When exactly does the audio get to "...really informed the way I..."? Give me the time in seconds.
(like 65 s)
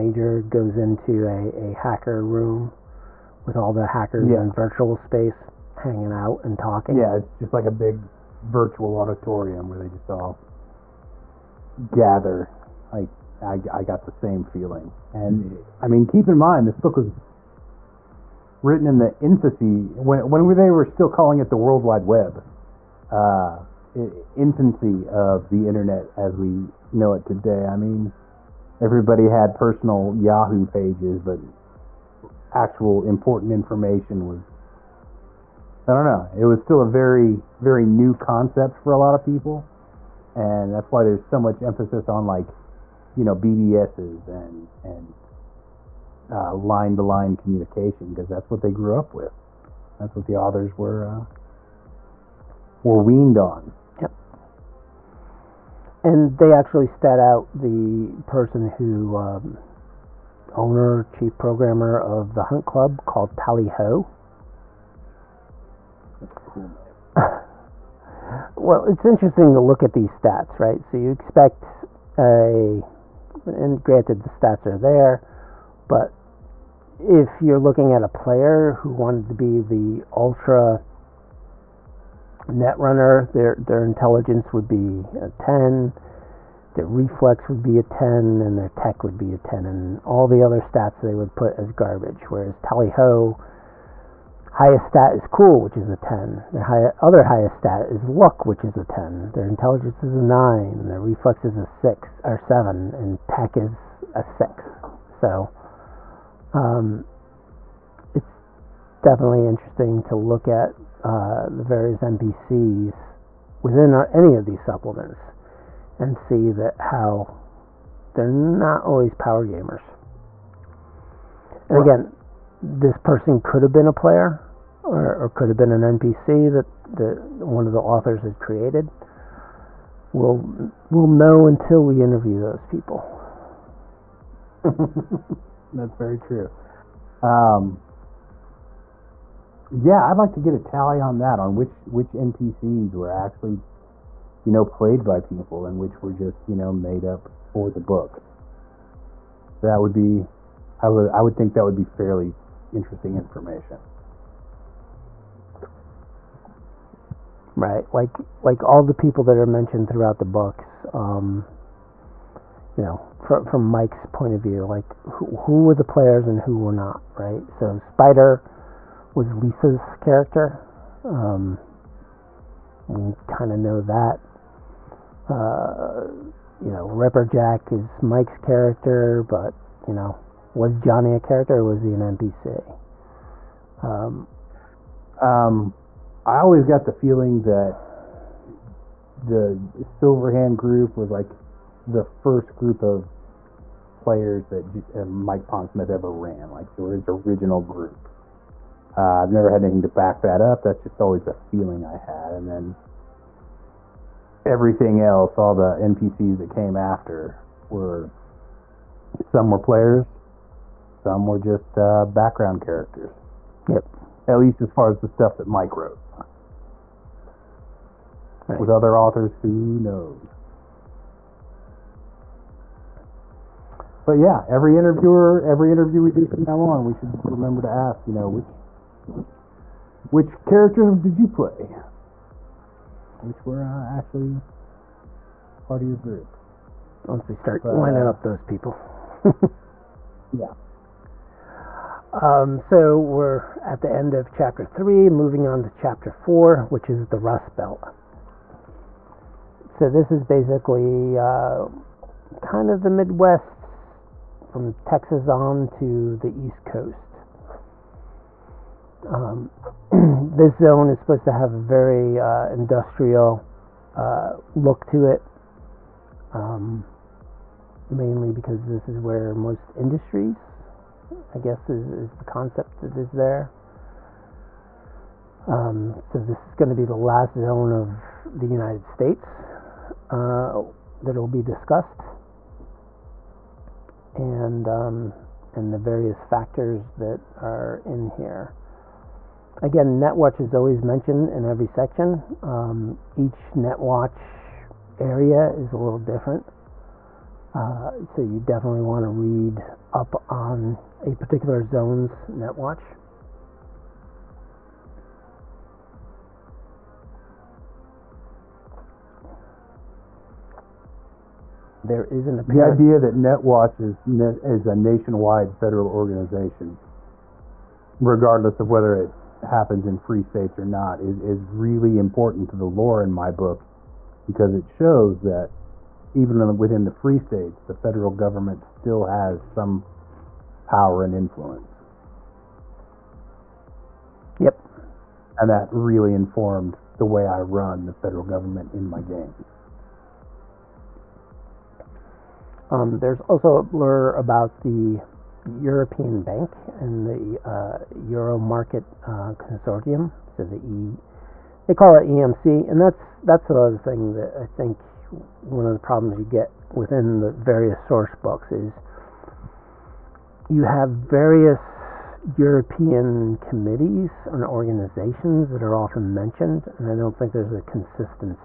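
335 s.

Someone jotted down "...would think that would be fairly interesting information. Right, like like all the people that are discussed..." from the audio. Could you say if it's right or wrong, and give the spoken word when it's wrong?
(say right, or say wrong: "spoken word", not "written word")
wrong: "mentioned", not "discussed".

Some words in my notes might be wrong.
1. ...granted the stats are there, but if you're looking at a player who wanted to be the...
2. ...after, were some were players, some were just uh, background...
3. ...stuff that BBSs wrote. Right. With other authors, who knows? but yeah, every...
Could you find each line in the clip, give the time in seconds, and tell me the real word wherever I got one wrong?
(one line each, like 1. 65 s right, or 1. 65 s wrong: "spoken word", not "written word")
1. 73 s right
2. 206 s right
3. 215 s wrong: "Mike", not "BBSs".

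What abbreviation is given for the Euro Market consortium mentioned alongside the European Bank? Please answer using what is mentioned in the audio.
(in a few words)
EMC.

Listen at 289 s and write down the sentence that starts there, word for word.
Again, NetWatch is always mentioned in every section.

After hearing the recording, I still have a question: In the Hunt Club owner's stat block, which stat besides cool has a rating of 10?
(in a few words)
Luck.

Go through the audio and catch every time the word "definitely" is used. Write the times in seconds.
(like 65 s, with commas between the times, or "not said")
109 s, 298 s.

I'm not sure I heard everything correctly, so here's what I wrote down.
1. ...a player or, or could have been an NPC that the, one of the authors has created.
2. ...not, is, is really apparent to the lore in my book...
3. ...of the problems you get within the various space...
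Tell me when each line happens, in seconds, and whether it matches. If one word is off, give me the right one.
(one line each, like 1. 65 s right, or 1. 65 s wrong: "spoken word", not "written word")
1. 123 s right
2. 320 s wrong: "important", not "apparent"
3. 355 s wrong: "source", not "space".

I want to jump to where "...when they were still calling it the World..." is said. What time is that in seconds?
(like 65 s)
20 s.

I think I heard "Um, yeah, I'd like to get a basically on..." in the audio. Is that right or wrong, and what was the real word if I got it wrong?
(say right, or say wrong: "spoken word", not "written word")
wrong: "tally", not "basically".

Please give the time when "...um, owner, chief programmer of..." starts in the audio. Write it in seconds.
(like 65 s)
59 s.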